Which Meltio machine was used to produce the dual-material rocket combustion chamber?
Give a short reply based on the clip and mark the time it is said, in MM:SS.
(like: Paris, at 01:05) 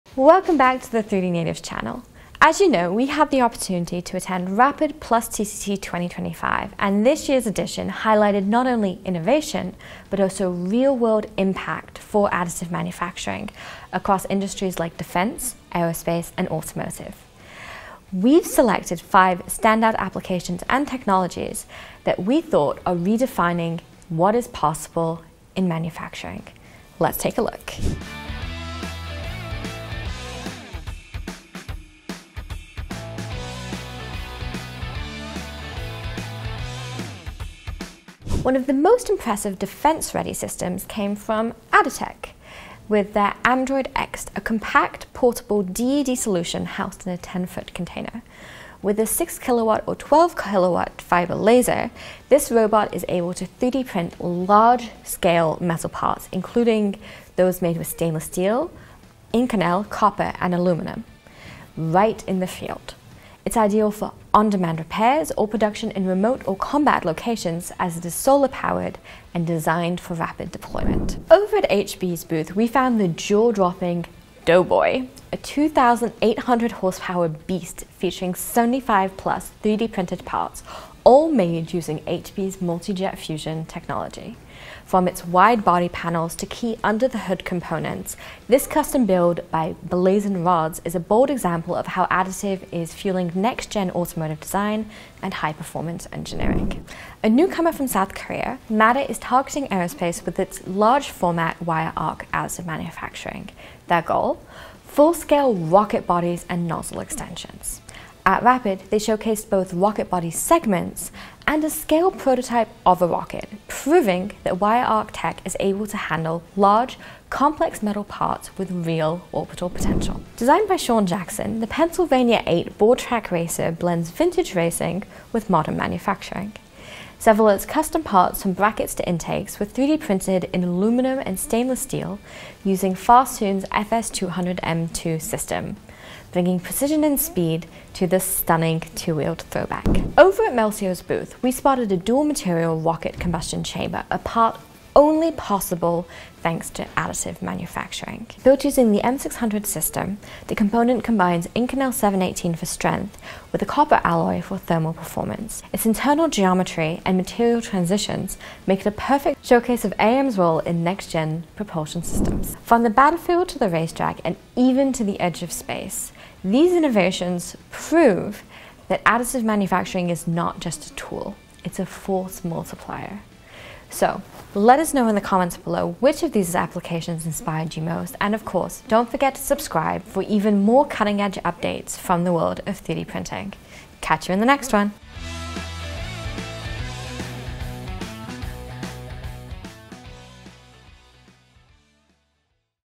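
M600, at 02:29.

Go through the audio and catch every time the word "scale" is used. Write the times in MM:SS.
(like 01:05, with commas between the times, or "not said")
00:55, 01:45, 01:51.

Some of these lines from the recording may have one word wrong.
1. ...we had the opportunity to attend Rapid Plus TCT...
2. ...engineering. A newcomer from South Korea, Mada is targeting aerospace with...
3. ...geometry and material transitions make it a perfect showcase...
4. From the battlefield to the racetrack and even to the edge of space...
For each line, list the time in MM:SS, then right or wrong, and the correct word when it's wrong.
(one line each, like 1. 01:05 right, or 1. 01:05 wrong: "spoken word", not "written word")
1. 00:02 right
2. 01:36 right
3. 02:36 right
4. 02:42 right.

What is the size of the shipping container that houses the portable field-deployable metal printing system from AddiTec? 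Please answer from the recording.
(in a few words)
10-foot.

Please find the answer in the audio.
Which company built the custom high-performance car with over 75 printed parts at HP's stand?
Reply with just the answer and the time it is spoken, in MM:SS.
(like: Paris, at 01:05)
Blazin Rods, at 01:29.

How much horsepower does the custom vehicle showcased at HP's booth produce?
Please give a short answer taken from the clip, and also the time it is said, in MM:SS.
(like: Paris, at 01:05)
2,800, at 01:15.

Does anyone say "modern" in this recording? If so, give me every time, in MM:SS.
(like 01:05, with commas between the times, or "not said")
02:05.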